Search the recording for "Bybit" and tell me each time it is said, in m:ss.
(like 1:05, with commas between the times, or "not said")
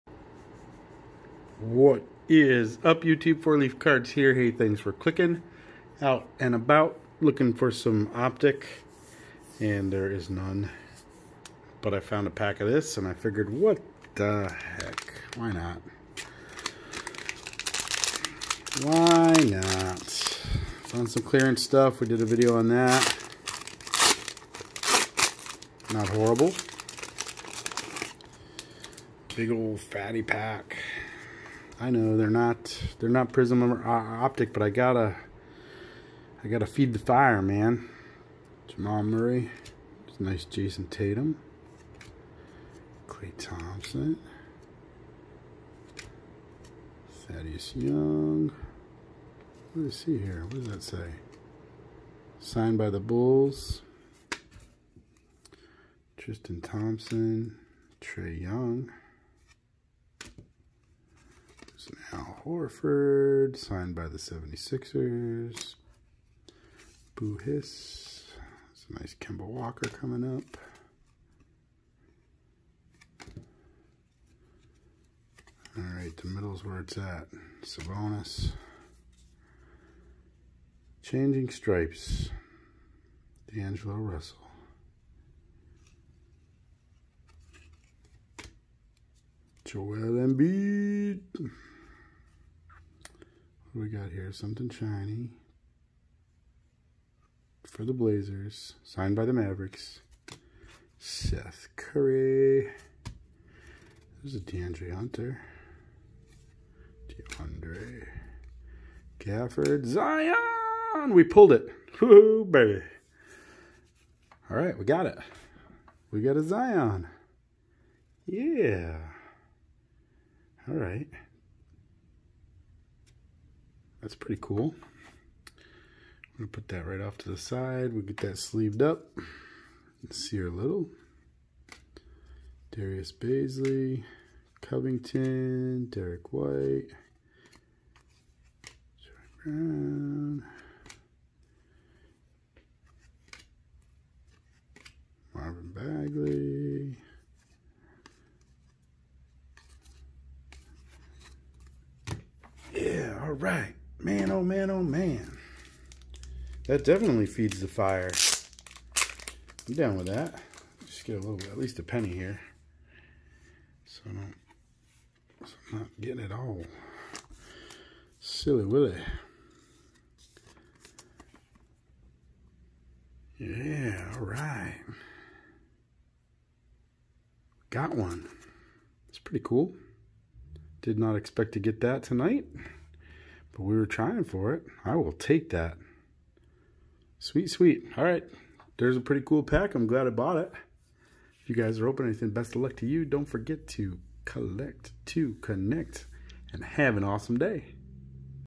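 not said.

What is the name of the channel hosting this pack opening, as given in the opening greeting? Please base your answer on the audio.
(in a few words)
Four Leaf Cards.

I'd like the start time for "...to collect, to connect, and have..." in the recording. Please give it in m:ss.
3:13.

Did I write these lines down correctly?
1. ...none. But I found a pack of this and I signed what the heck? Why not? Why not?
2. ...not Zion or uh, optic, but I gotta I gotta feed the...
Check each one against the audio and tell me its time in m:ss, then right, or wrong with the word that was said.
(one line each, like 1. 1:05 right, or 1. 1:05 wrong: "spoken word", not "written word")
1. 0:10 wrong: "figured", not "signed"
2. 0:33 wrong: "Prizm", not "Zion".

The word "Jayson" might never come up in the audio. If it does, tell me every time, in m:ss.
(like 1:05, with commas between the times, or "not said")
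0:40.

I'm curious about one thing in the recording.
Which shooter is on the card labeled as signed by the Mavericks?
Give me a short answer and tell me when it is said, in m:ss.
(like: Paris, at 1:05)
Seth Curry, at 1:40.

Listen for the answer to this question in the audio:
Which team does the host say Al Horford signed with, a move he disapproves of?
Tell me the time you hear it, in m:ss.
1:04.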